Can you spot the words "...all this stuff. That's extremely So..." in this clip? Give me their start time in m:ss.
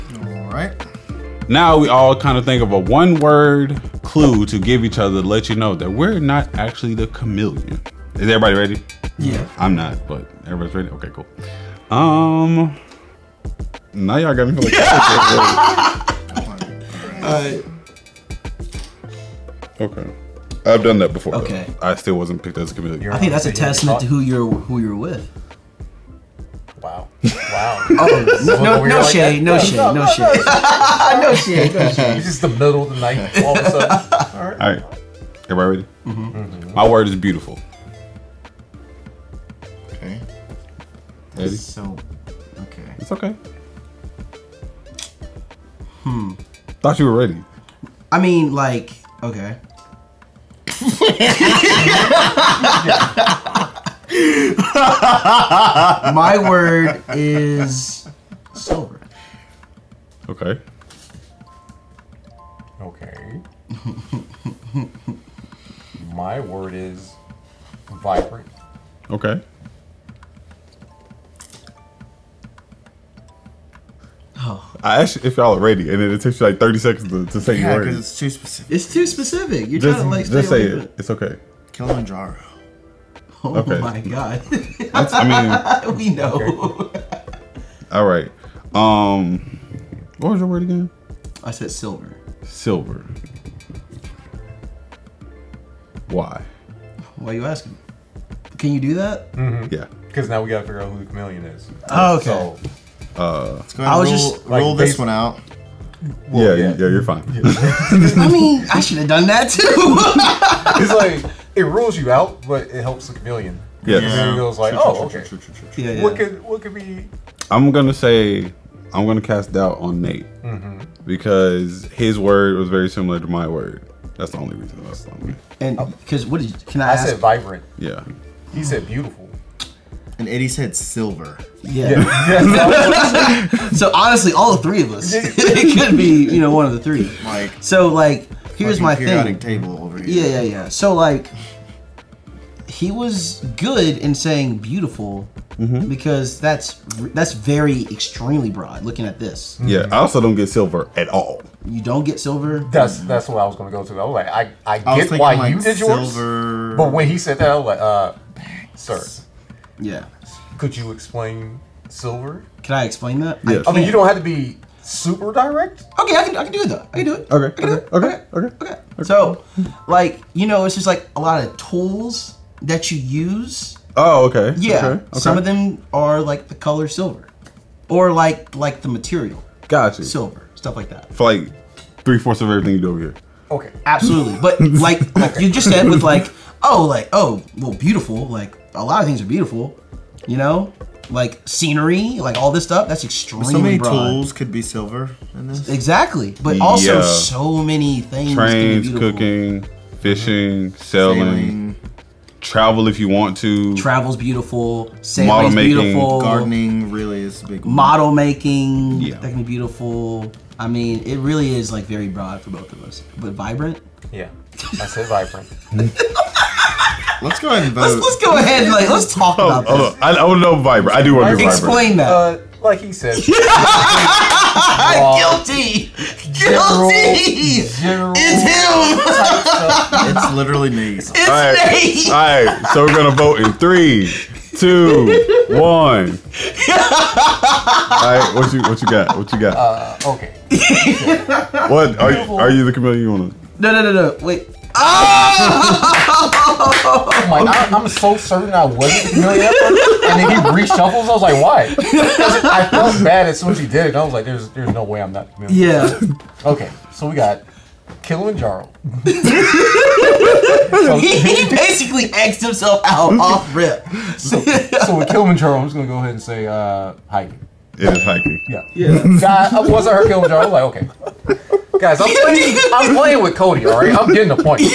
3:12.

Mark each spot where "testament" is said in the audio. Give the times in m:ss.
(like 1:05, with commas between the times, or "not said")
0:23.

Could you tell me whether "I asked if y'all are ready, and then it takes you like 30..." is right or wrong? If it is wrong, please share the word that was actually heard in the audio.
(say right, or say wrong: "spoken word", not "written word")
right.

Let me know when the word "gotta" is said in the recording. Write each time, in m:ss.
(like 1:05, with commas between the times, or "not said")
1:40.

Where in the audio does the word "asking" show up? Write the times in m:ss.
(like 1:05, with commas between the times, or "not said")
1:37.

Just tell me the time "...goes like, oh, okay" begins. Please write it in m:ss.
1:54.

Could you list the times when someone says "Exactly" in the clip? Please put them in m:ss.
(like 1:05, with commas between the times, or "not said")
3:15.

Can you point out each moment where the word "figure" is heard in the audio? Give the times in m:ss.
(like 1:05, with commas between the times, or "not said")
1:40.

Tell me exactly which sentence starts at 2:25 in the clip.
because that's that's very extremely broad.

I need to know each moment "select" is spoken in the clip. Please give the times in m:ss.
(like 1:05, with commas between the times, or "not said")
not said.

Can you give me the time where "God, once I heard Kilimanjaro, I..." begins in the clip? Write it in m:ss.
4:29.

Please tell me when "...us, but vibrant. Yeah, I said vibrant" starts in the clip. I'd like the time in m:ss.
3:32.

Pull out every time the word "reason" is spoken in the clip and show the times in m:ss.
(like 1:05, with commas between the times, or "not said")
2:04.